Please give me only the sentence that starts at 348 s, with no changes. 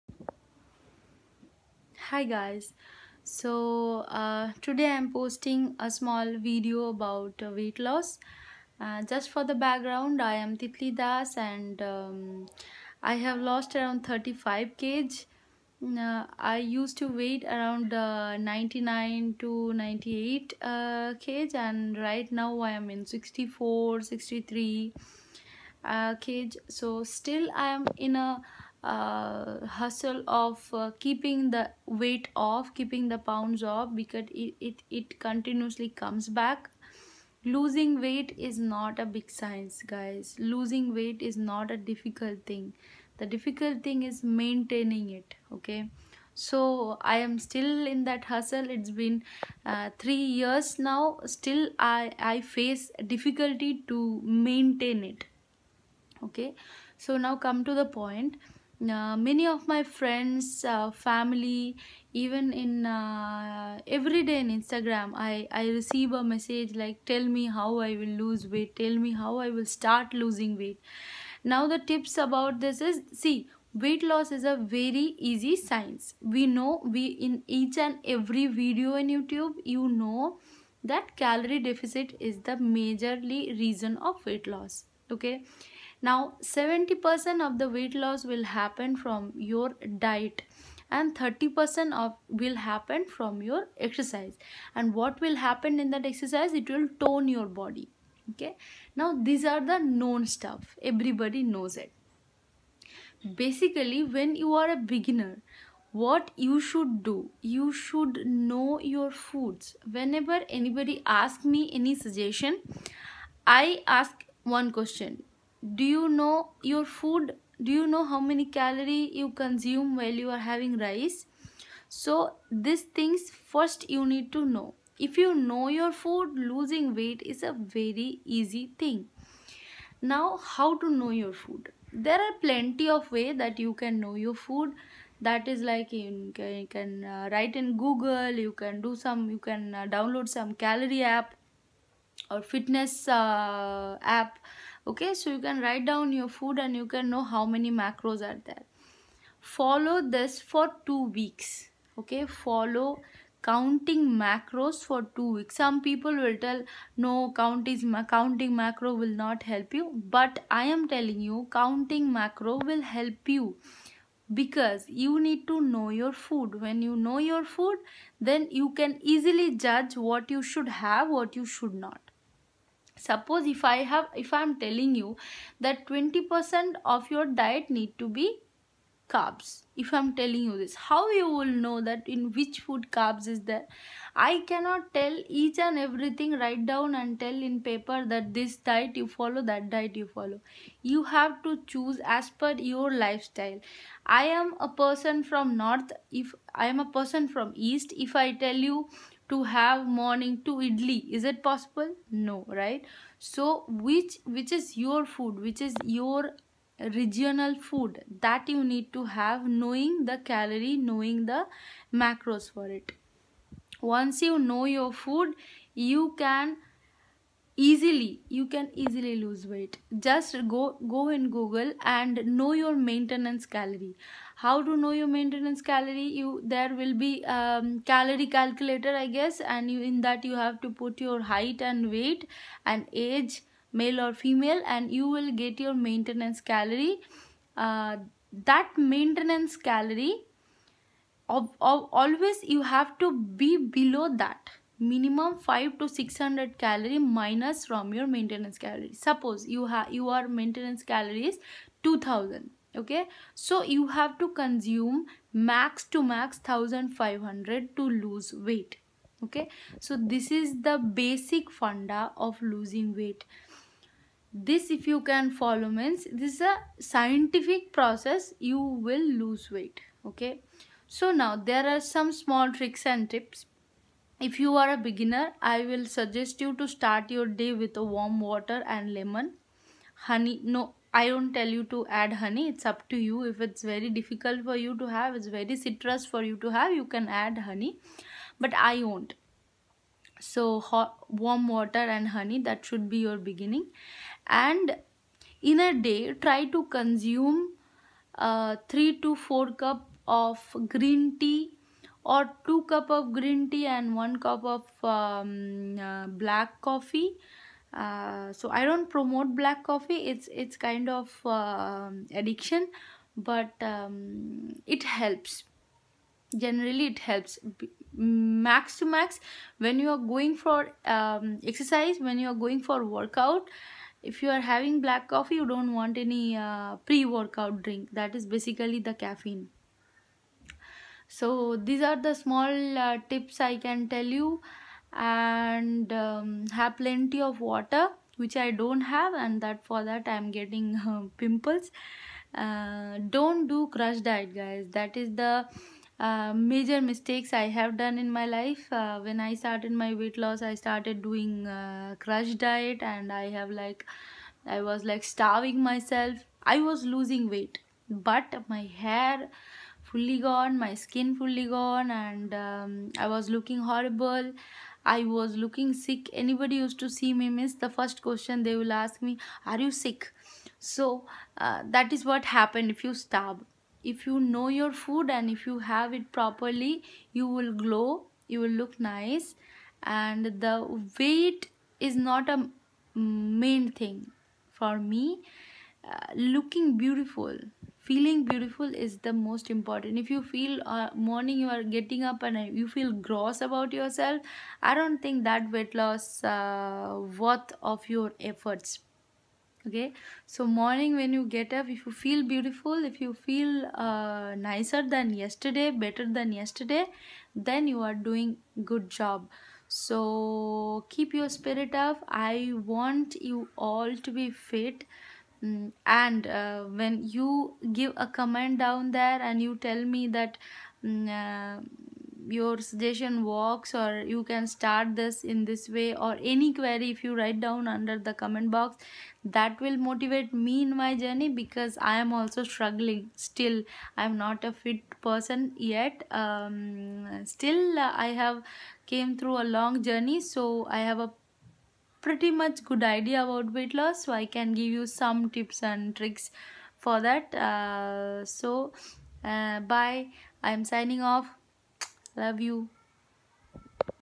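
Uh, when I started my weight loss, I started doing uh, crush diet and I have like, I was like starving myself.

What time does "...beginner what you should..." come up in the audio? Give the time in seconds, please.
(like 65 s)
104 s.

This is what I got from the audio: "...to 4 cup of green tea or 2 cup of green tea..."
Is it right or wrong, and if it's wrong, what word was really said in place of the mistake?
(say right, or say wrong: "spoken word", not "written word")
right.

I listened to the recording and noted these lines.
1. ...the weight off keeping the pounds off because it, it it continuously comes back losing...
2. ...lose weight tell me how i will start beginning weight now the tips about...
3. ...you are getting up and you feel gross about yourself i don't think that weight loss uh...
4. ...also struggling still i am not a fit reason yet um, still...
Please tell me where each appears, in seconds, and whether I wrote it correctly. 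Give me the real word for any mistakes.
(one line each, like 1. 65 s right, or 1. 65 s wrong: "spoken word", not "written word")
1. 31 s right
2. 68 s wrong: "losing", not "beginning"
3. 391 s right
4. 432 s wrong: "person", not "reason".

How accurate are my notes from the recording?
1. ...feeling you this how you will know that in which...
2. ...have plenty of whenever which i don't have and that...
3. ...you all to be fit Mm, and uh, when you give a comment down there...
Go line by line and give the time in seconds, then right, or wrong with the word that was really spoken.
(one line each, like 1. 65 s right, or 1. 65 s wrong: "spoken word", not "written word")
1. 180 s wrong: "telling", not "feeling"
2. 336 s wrong: "water", not "whenever"
3. 413 s right.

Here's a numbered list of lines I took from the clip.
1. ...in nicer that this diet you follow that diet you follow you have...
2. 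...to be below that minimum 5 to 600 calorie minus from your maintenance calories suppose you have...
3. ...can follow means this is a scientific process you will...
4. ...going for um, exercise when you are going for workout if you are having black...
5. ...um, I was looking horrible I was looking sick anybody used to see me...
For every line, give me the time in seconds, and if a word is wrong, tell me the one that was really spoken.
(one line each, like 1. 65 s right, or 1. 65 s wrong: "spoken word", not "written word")
1. 187 s wrong: "paper", not "nicer"
2. 242 s right
3. 265 s right
4. 319 s right
5. 362 s right.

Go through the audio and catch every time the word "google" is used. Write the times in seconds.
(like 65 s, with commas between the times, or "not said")
137 s, 221 s.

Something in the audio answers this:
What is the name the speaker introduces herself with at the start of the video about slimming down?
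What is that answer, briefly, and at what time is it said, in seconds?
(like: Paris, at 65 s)
Titli Das, at 10 s.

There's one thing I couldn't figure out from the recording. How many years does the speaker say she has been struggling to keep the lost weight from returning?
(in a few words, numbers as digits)
3.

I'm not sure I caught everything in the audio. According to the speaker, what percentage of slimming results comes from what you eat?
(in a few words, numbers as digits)
70%.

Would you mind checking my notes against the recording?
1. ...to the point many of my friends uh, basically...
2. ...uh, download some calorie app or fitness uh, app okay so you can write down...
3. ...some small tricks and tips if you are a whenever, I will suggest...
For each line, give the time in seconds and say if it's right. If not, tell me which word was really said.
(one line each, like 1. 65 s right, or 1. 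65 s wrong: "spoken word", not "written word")
1. 57 s wrong: "family", not "basically"
2. 139 s right
3. 271 s wrong: "beginner", not "whenever".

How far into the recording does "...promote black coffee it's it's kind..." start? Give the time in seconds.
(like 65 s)
308 s.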